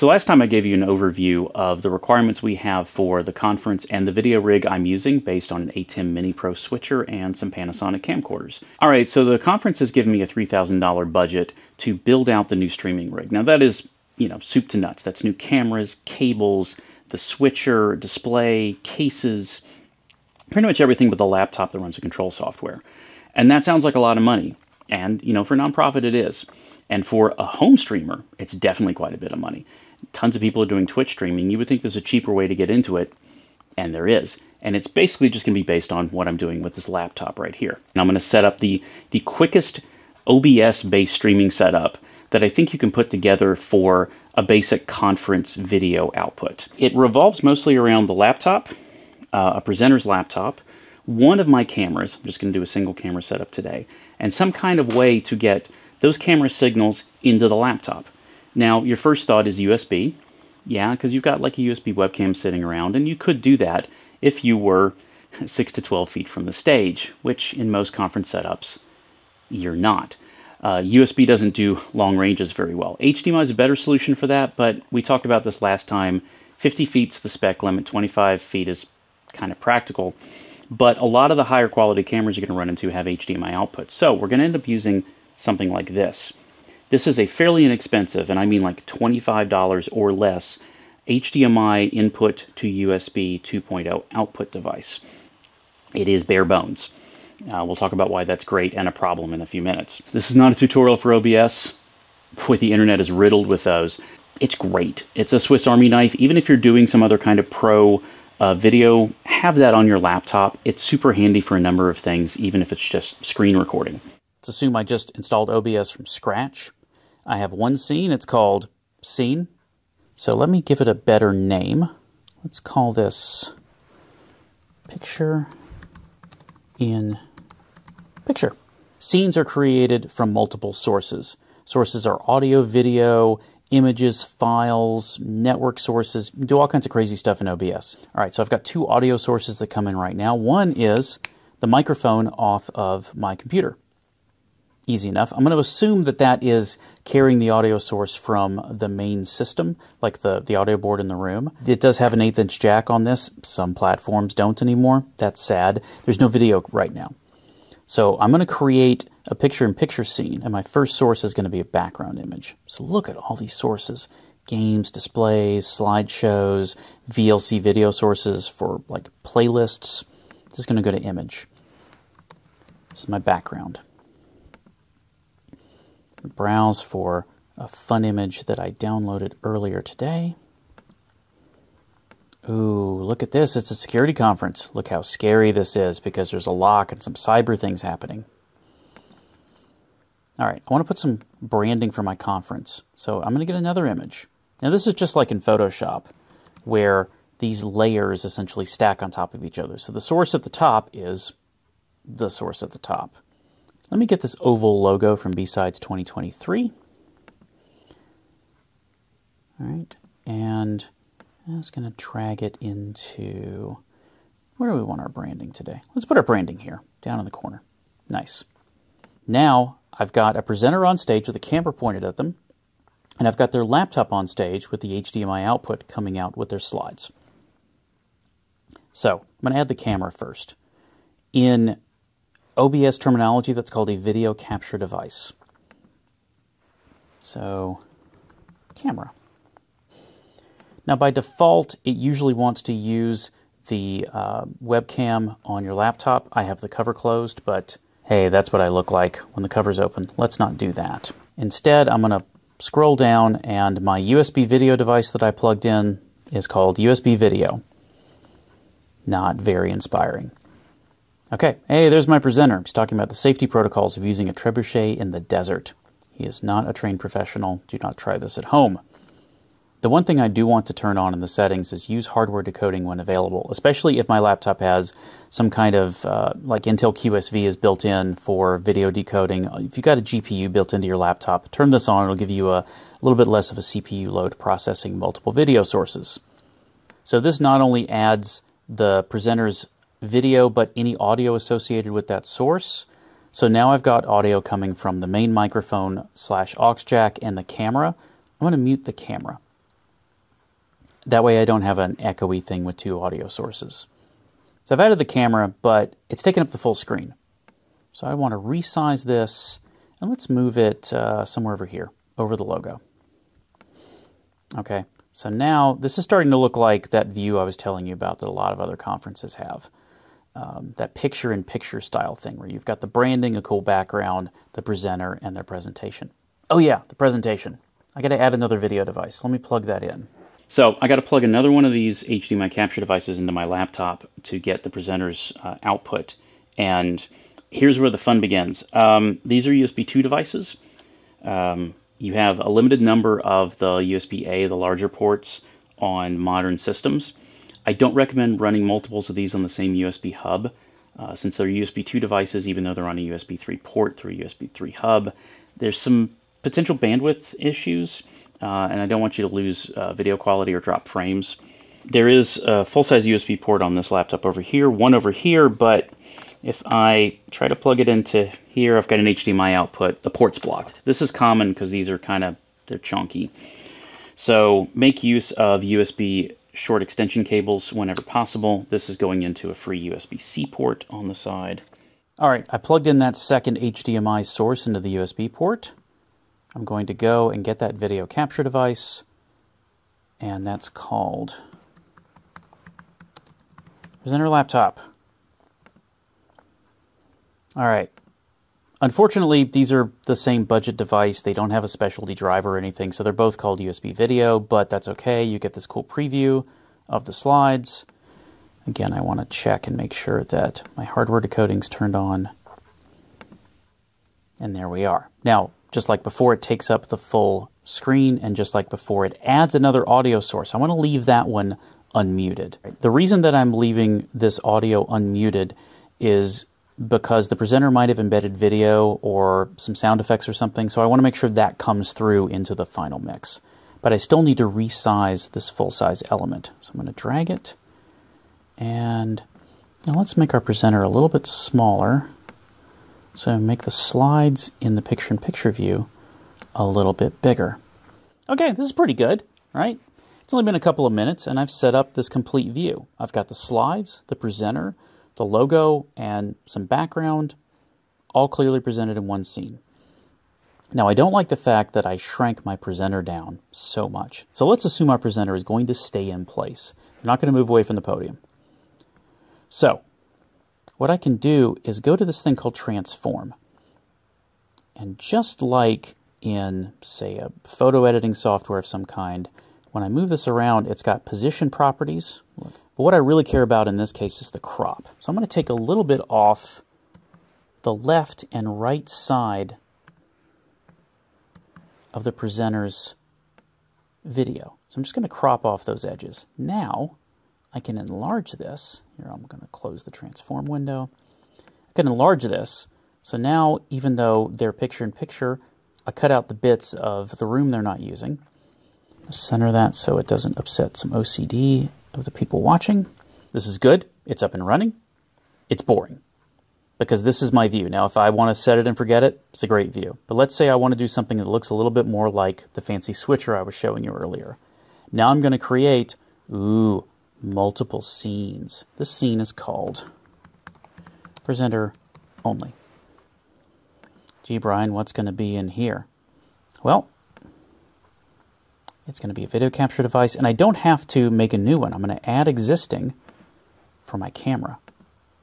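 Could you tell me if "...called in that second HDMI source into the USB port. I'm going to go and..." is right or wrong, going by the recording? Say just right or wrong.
wrong.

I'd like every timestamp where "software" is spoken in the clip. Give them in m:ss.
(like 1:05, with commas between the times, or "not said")
0:22, 7:58.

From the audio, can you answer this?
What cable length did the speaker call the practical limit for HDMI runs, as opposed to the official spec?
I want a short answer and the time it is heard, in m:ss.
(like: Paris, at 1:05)
25 feet, at 1:17.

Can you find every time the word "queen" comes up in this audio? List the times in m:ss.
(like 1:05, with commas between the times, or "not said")
not said.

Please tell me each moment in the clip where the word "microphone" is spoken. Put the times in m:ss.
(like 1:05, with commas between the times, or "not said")
2:21, 4:55.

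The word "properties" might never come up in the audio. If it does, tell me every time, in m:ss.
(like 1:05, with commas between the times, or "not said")
8:01.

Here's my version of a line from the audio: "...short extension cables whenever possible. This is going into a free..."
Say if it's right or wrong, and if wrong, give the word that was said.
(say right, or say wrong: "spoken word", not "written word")
right.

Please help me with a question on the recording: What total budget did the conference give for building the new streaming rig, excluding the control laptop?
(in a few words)
$3,000.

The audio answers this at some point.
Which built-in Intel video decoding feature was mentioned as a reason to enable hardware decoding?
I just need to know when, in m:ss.
4:36.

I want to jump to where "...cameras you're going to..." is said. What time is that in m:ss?
1:22.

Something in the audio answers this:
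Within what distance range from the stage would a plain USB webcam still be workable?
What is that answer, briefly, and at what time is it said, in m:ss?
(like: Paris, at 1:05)
6 to 12 feet, at 1:05.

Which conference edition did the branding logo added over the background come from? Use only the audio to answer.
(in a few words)
B-Sides 2023.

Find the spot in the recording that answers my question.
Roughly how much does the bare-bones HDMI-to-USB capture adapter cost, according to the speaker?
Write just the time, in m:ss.
1:28.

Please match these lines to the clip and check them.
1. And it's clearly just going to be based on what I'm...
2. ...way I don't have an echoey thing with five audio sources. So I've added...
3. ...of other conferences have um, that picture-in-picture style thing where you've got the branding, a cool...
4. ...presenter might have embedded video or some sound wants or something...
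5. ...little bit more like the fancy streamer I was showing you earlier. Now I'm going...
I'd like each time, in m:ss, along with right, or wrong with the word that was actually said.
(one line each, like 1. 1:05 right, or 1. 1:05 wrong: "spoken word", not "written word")
1. 0:34 wrong: "basically", not "clearly"
2. 5:01 wrong: "two", not "five"
3. 5:18 right
4. 7:07 wrong: "effects", not "wants"
5. 8:41 wrong: "switcher", not "streamer".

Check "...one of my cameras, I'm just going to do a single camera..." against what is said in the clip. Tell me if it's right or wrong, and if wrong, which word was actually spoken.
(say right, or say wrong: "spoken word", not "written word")
right.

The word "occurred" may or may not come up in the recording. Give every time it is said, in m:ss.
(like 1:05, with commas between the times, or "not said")
not said.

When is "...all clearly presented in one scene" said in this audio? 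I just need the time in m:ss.
7:38.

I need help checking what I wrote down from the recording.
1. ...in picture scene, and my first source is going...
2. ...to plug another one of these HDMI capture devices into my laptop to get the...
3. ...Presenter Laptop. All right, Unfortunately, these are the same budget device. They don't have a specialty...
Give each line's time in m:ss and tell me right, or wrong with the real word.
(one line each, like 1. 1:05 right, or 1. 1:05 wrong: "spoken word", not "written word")
1. 2:39 right
2. 5:30 right
3. 6:34 right.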